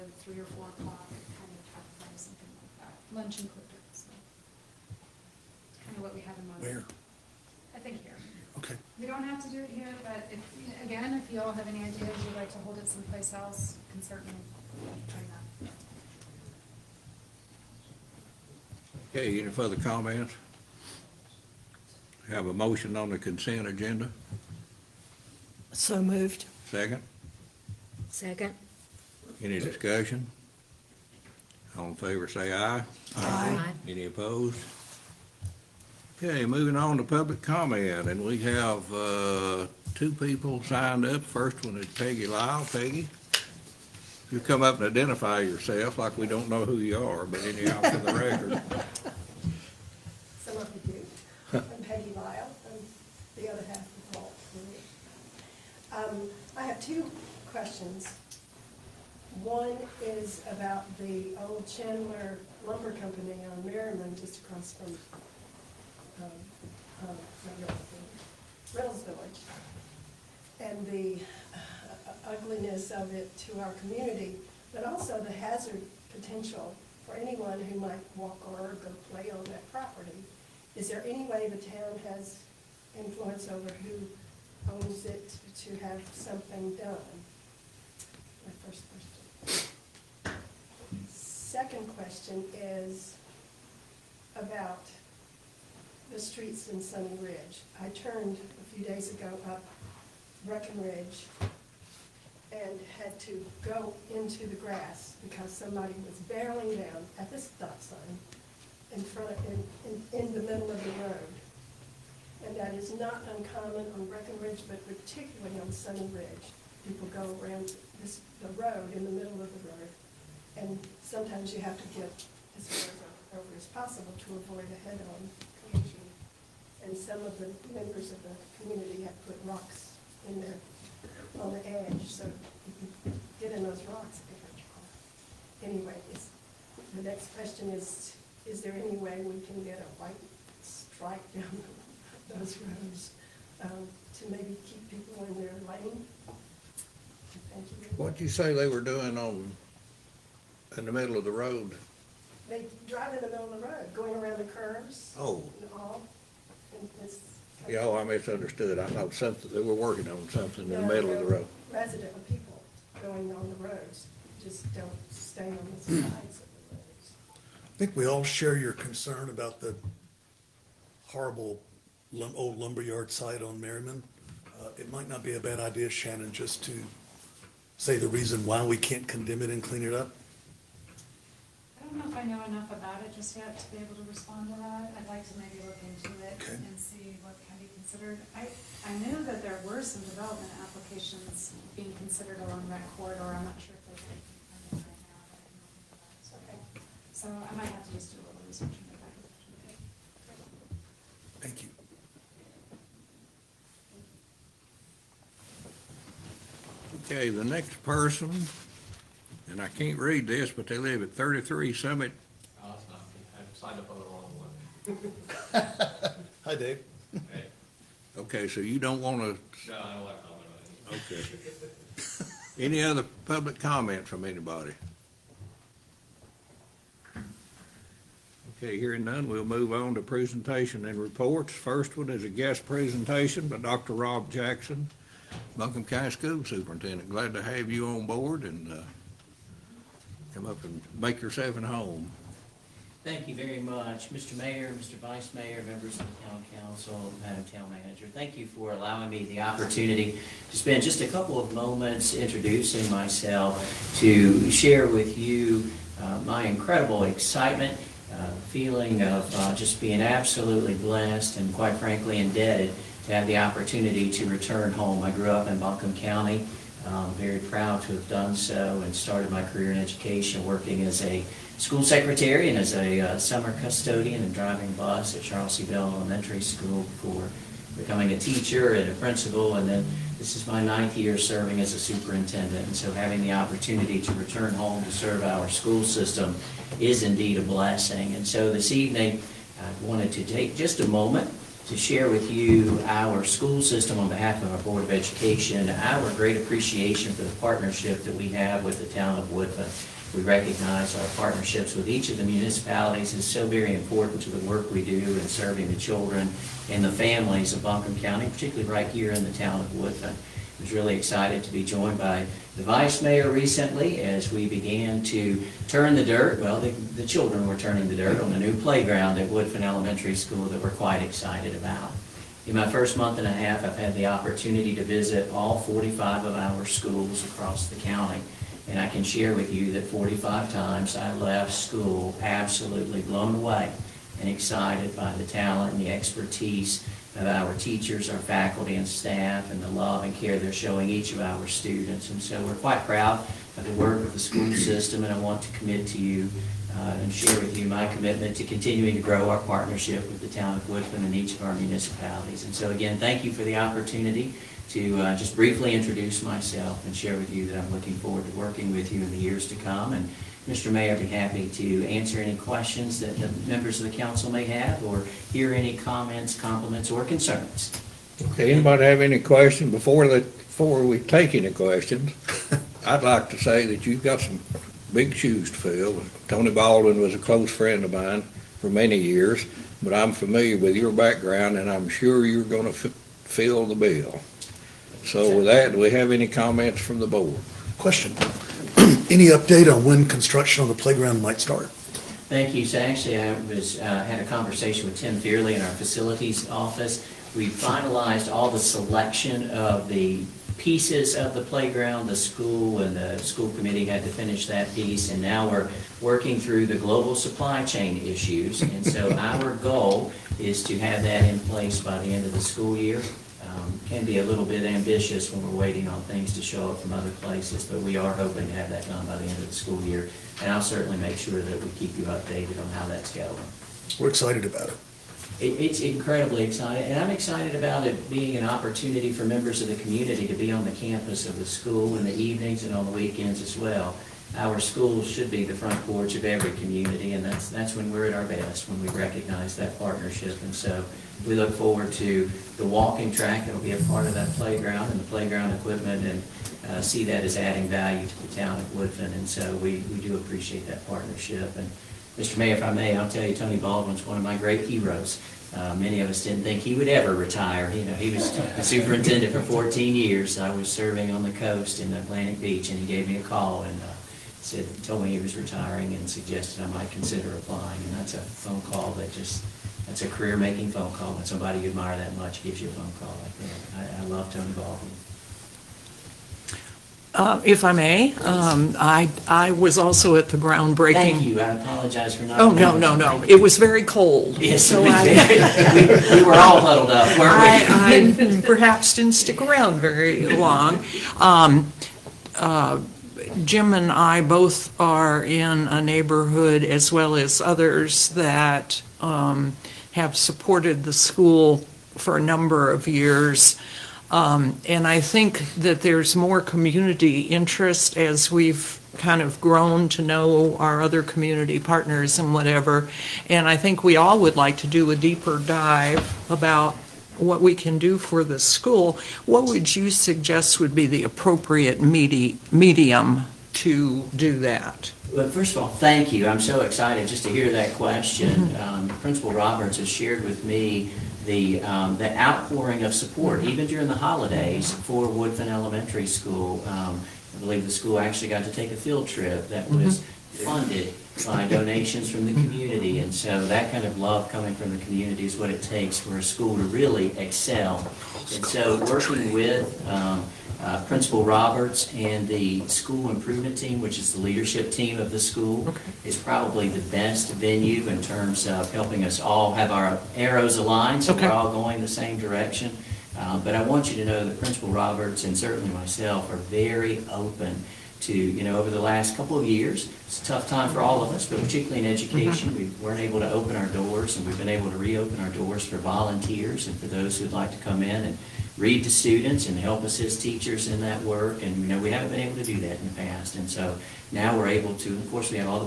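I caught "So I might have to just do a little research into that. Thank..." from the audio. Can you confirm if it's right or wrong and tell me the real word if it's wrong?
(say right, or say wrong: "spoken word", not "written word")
right.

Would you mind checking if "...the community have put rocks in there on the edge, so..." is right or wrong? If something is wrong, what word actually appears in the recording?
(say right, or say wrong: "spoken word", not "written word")
right.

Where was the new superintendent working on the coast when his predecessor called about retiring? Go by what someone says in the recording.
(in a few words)
Atlantic Beach.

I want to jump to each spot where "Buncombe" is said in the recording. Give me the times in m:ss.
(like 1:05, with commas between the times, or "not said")
3:55, 4:25, 5:07.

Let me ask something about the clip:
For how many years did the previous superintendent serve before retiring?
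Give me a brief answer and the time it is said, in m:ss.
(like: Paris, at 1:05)
14, at 7:39.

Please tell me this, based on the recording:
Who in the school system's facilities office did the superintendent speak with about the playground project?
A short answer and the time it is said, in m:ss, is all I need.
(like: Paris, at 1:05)
Tim Fearley, at 6:34.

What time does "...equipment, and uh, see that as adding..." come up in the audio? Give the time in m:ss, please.
7:25.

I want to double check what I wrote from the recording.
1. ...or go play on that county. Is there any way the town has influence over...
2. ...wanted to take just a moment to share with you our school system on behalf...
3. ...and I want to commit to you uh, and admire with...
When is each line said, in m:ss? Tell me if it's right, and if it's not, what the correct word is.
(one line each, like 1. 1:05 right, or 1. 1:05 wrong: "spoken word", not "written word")
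1. 1:18 wrong: "property", not "county"
2. 4:49 right
3. 5:45 wrong: "share", not "admire".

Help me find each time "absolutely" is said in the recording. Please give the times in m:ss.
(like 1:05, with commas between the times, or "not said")
4:20, 5:32.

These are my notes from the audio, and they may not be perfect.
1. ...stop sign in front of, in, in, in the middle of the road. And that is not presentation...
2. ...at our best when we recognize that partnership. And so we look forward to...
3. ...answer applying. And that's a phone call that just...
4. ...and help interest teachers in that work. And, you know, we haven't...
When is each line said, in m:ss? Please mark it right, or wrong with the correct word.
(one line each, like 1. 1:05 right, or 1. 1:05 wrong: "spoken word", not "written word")
1. 1:47 wrong: "uncommon", not "presentation"
2. 7:18 right
3. 7:46 wrong: "consider", not "answer"
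4. 9:39 wrong: "assist", not "interest".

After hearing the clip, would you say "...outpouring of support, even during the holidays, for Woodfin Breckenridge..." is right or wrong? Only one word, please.
wrong.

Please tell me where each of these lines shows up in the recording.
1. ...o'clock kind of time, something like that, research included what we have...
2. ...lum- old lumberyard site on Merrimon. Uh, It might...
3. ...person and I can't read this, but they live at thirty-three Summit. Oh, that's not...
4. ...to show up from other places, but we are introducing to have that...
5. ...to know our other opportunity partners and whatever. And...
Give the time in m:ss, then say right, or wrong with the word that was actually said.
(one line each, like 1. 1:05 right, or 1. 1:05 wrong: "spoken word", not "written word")
1. 0:00 wrong: "lunch", not "research"
2. 2:52 right
3. 3:27 right
4. 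6:56 wrong: "hoping", not "introducing"
5. 8:29 wrong: "community", not "opportunity".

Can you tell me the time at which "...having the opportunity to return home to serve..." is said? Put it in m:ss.
4:42.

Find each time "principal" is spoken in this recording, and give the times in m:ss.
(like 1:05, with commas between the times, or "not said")
4:38, 8:48, 9:10, 9:24.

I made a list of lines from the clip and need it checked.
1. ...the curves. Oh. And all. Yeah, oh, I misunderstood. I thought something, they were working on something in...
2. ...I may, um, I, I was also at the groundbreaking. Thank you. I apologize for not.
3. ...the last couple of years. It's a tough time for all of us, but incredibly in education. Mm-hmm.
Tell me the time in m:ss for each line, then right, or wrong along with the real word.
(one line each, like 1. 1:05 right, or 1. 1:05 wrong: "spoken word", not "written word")
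1. 2:34 right
2. 7:57 right
3. 9:28 wrong: "particularly", not "incredibly".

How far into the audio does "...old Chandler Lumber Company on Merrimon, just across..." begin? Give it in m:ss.
1:01.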